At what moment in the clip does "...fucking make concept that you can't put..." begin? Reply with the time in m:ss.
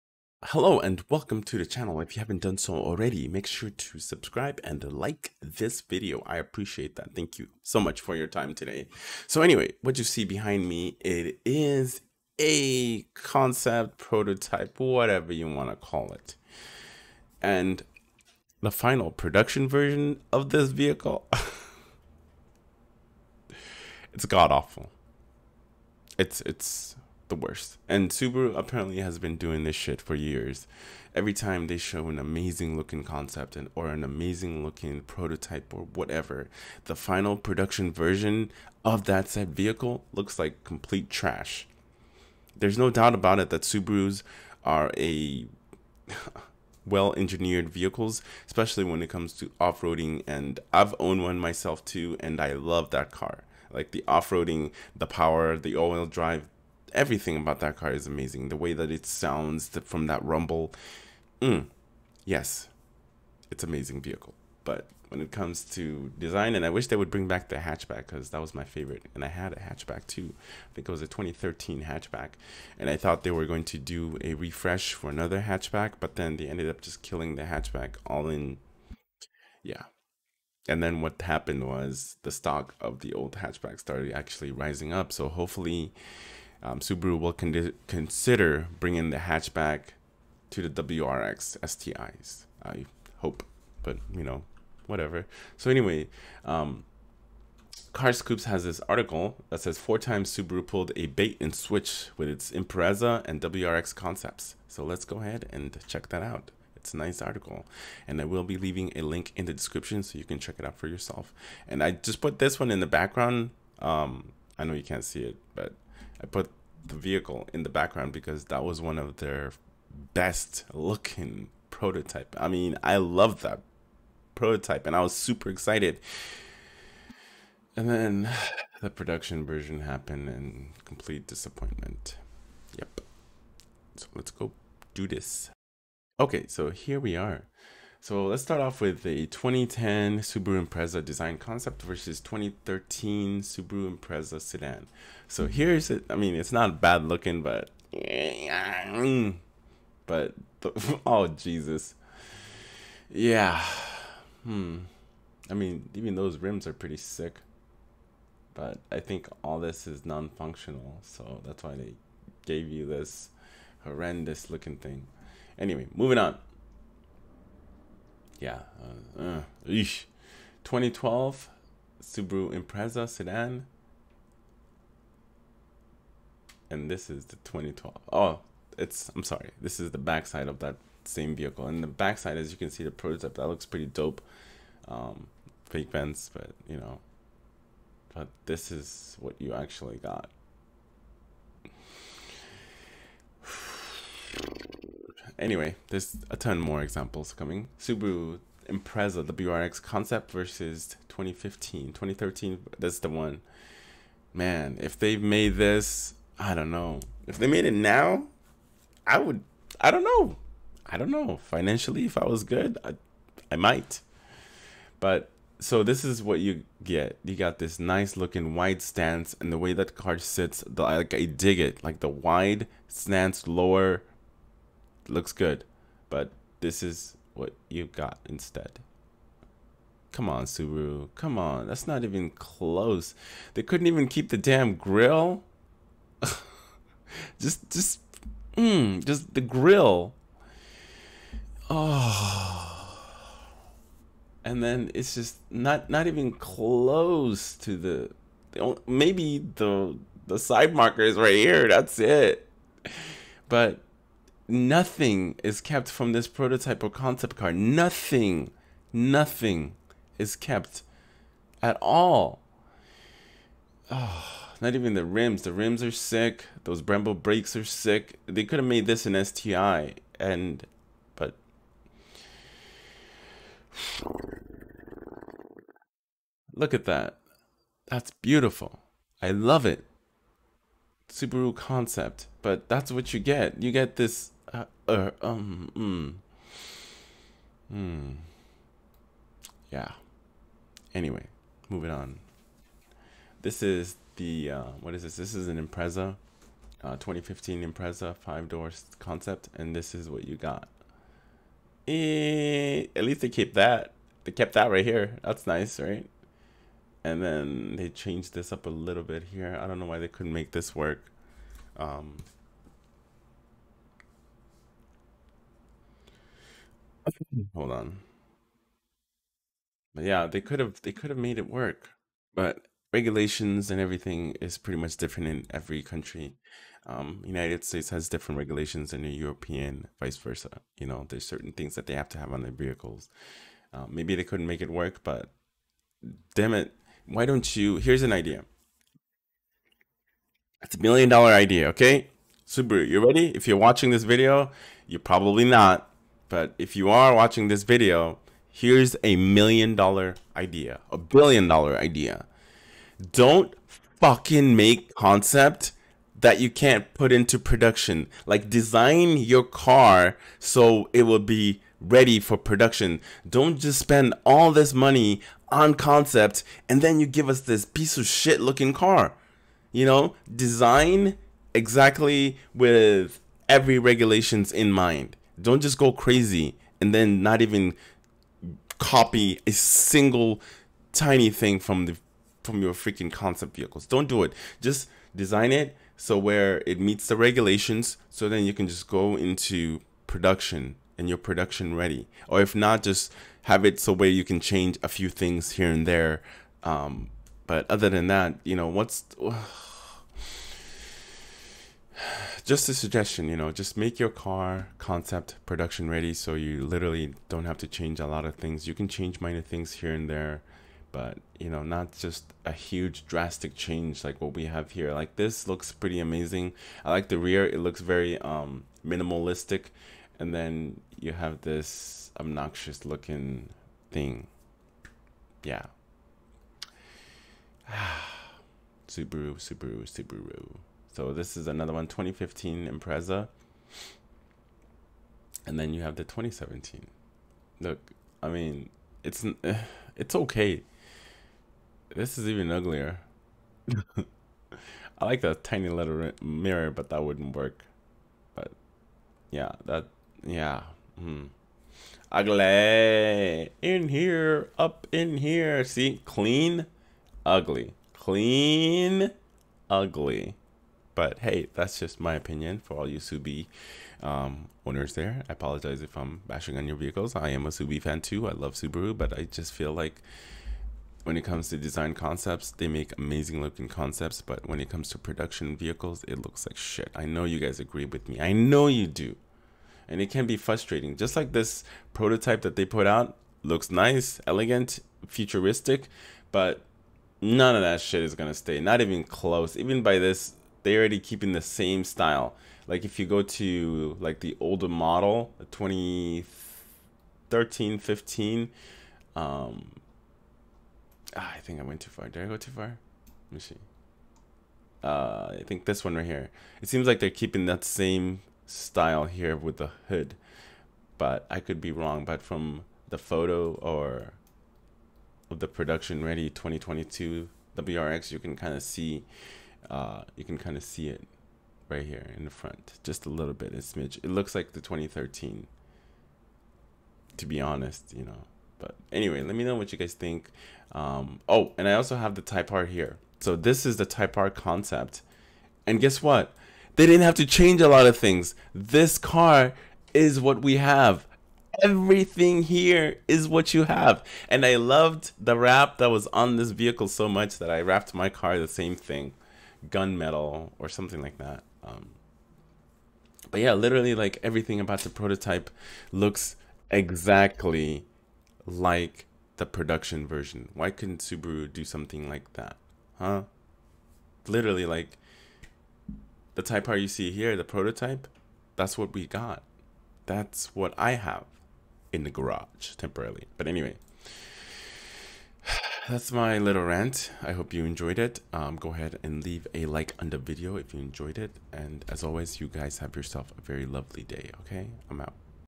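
5:53.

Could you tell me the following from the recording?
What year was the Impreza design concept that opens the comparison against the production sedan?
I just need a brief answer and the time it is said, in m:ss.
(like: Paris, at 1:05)
2010, at 2:19.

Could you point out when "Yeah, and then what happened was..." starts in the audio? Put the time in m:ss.
1:19.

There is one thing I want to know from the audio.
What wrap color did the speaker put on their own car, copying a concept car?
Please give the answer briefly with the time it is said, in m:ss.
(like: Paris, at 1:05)
Gunmetal, at 9:09.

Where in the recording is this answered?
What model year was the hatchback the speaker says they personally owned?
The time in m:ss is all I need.
1:11.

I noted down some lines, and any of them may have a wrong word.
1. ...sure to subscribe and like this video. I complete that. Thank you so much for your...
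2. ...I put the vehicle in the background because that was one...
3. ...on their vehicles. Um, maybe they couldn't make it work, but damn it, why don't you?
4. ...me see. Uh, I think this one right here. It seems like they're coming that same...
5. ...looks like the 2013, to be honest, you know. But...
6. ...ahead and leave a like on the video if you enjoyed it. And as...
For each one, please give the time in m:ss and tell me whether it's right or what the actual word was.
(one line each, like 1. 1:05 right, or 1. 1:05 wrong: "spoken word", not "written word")
1. 0:03 wrong: "appreciate", not "complete"
2. 1:56 right
3. 5:32 right
4. 8:23 wrong: "keeping", not "coming"
5. 8:44 right
6. 9:38 right.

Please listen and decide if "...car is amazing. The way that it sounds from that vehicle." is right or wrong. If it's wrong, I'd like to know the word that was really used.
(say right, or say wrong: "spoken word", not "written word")
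wrong: "rumble", not "vehicle".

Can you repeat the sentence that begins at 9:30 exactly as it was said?
That's what I have in the garage temporarily.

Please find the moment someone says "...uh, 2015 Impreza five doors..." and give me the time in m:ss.
4:56.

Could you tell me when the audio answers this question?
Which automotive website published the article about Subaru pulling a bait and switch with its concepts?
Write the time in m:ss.
1:37.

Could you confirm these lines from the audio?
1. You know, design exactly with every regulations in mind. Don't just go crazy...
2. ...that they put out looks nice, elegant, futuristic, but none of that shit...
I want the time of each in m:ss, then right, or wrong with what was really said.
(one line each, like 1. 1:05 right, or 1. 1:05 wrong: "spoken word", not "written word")
1. 6:09 right
2. 8:02 right.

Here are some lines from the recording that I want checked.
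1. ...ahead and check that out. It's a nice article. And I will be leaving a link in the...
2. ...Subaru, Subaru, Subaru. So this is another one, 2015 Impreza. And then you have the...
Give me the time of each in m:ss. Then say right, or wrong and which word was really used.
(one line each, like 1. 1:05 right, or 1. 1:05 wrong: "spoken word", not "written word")
1. 1:45 right
2. 7:08 right.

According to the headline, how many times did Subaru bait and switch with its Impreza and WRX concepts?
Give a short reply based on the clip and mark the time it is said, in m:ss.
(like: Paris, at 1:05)
4, at 1:39.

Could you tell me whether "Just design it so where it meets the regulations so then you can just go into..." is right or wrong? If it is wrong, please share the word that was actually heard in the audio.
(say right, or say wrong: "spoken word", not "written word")
right.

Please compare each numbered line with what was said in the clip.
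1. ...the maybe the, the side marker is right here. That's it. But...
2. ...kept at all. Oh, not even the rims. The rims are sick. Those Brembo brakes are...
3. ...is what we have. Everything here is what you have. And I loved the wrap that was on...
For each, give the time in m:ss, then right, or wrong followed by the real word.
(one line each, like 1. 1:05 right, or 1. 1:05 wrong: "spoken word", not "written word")
1. 4:08 right
2. 4:20 right
3. 8:59 right.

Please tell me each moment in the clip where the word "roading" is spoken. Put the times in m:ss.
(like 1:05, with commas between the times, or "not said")
0:49, 0:54.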